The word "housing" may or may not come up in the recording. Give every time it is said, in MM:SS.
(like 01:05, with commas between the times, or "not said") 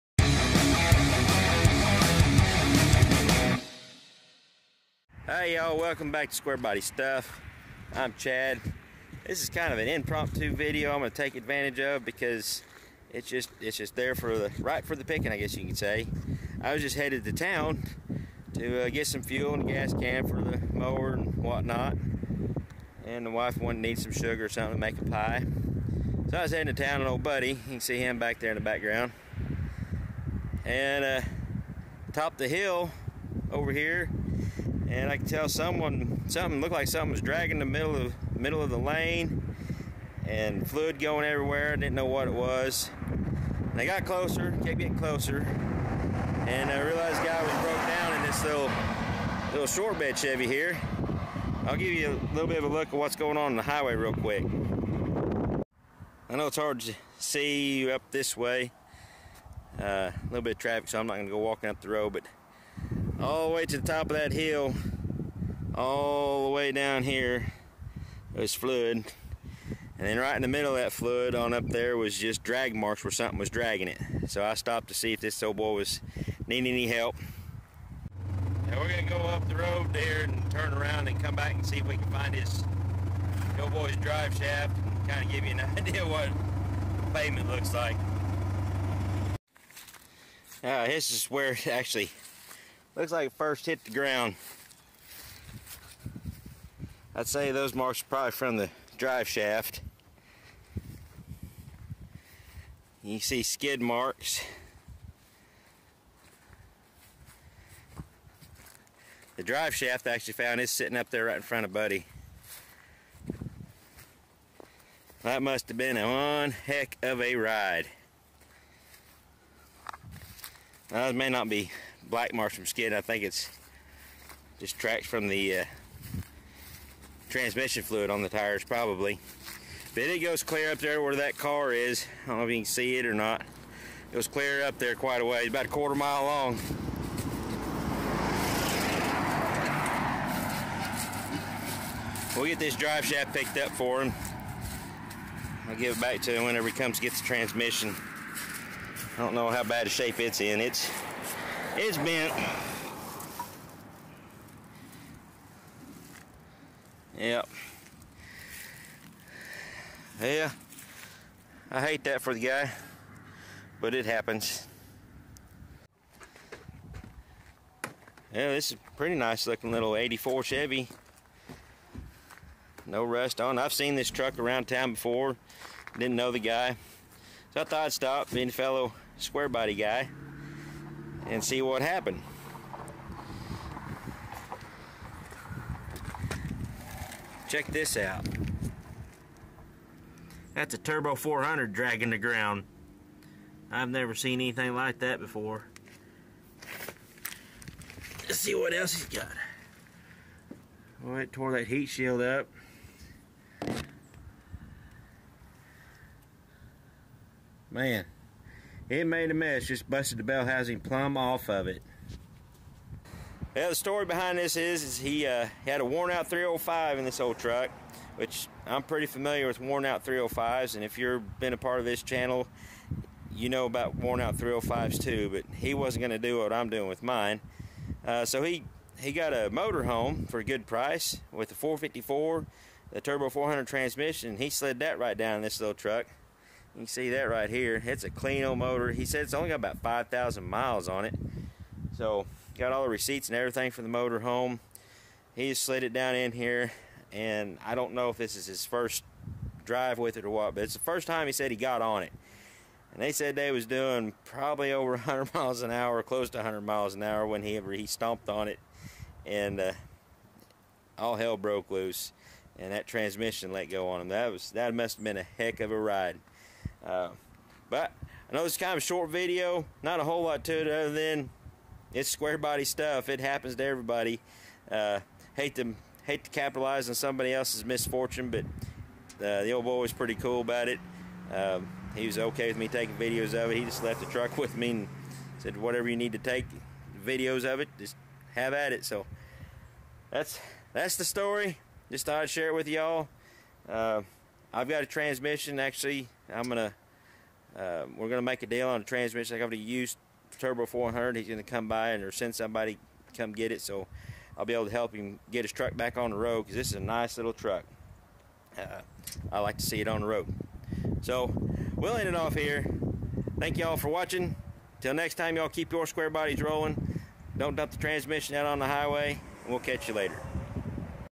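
03:30.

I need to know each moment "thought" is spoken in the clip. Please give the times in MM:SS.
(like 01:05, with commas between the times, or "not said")
02:57, 04:52.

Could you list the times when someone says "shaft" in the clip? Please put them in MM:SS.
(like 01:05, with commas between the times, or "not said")
01:24, 01:39, 01:49, 02:23.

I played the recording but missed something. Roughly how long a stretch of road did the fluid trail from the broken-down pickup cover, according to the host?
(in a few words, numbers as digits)
quarter mile.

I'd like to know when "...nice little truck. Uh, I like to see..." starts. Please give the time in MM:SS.
05:06.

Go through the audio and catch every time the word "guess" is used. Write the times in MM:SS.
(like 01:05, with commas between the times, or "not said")
00:15.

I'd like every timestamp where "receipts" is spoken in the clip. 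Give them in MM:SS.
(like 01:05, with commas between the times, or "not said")
04:02.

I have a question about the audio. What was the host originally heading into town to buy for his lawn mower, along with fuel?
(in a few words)
gas can.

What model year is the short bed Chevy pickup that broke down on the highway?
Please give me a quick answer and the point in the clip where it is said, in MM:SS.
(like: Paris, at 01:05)
84, at 02:49.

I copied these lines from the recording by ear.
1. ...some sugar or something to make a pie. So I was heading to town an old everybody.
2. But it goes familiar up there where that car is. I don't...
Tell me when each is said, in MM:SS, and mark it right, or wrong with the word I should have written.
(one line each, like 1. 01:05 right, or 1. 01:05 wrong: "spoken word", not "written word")
1. 00:23 wrong: "buddy", not "everybody"
2. 02:09 wrong: "clear", not "familiar".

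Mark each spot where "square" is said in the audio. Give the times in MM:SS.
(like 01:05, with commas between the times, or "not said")
00:06, 02:59, 04:32, 05:15.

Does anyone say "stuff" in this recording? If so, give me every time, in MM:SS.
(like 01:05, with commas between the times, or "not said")
00:06, 04:32.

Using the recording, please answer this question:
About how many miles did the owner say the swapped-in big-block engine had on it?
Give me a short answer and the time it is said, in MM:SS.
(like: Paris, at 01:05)
5,000, at 03:59.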